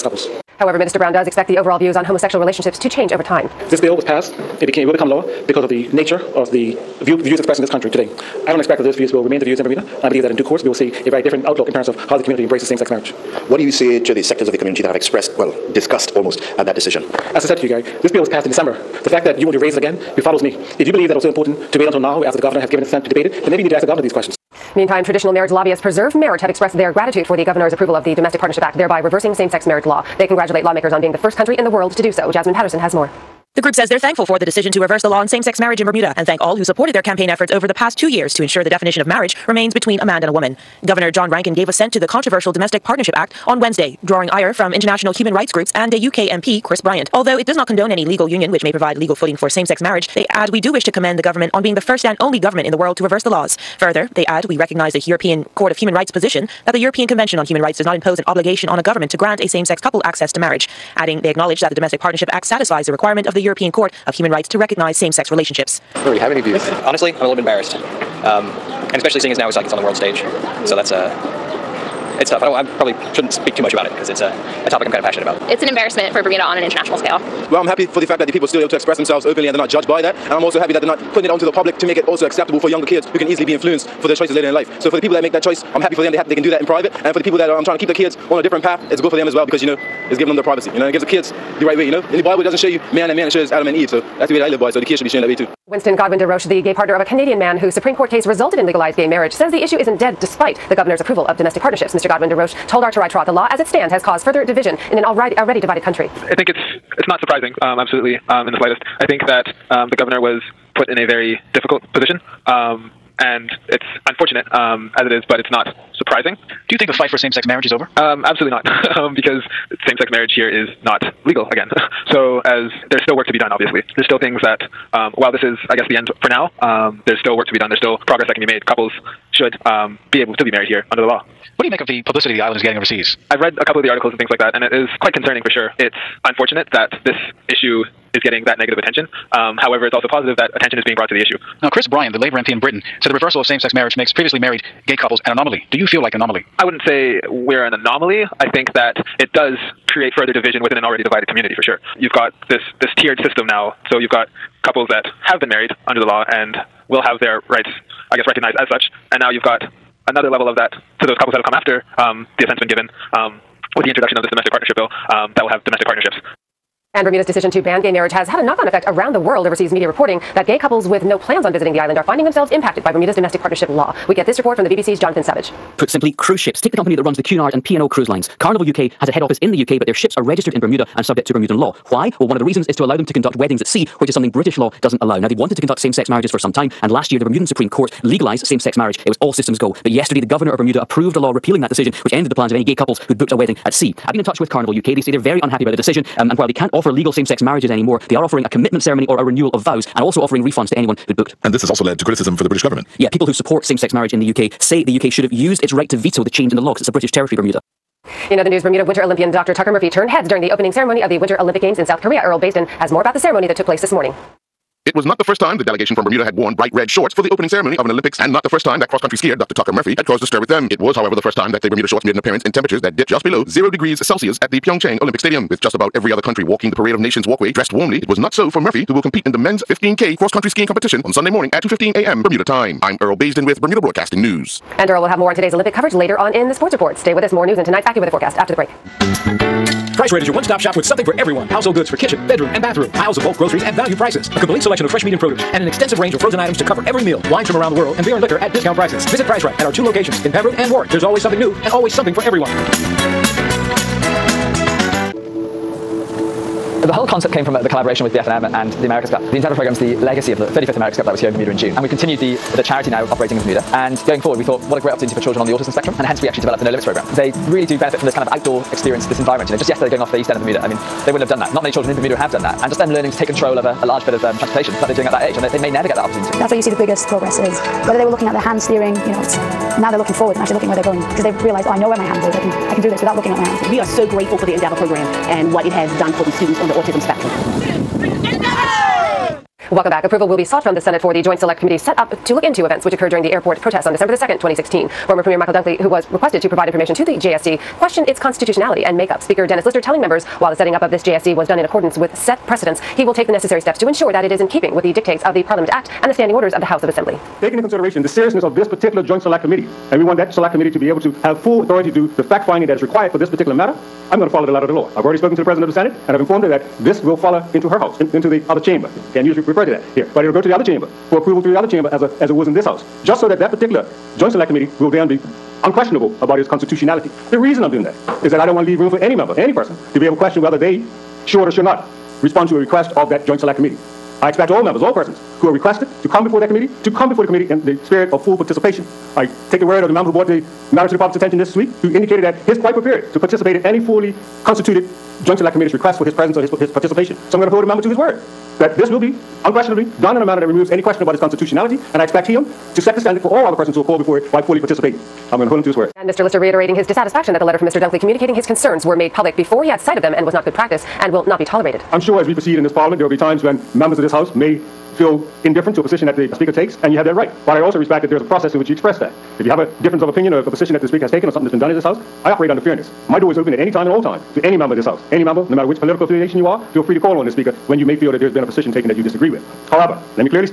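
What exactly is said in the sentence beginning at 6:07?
But I also respect that there is a process in which you express that.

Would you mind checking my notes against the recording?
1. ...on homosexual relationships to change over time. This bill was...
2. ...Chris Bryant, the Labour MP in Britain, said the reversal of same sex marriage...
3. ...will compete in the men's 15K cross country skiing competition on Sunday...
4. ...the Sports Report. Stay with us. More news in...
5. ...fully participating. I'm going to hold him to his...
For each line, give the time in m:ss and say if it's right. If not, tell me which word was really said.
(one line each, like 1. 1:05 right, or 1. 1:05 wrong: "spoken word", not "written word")
1. 0:01 right
2. 2:21 right
3. 3:48 right
4. 3:56 right
5. 5:54 right.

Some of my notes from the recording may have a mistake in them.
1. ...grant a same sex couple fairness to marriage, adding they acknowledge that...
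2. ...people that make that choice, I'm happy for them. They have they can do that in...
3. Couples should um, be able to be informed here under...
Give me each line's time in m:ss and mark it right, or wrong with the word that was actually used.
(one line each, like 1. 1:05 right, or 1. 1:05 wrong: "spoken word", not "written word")
1. 0:59 wrong: "access", not "fairness"
2. 1:24 right
3. 2:08 wrong: "married", not "informed".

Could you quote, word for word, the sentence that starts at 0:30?
They congratulate lawmakers on being the first country in the world to do so.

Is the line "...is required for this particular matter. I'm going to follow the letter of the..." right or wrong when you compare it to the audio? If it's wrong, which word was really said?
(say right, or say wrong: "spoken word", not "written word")
right.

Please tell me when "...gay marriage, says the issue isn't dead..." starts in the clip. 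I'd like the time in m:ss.
1:38.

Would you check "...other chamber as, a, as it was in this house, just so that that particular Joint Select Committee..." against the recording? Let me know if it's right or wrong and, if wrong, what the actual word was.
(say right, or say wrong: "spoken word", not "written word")
right.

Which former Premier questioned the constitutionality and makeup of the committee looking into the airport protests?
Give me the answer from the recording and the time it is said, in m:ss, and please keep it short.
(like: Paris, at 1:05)
Michael Dunkley, at 4:55.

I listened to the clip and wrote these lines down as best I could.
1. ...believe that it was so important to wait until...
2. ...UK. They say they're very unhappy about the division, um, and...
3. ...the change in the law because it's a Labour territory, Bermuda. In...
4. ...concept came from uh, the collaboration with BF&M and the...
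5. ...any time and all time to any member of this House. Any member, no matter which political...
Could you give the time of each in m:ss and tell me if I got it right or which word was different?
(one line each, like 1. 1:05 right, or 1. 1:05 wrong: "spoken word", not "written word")
1. 0:20 right
2. 3:14 wrong: "decision", not "division"
3. 3:26 wrong: "British", not "Labour"
4. 4:17 right
5. 6:13 right.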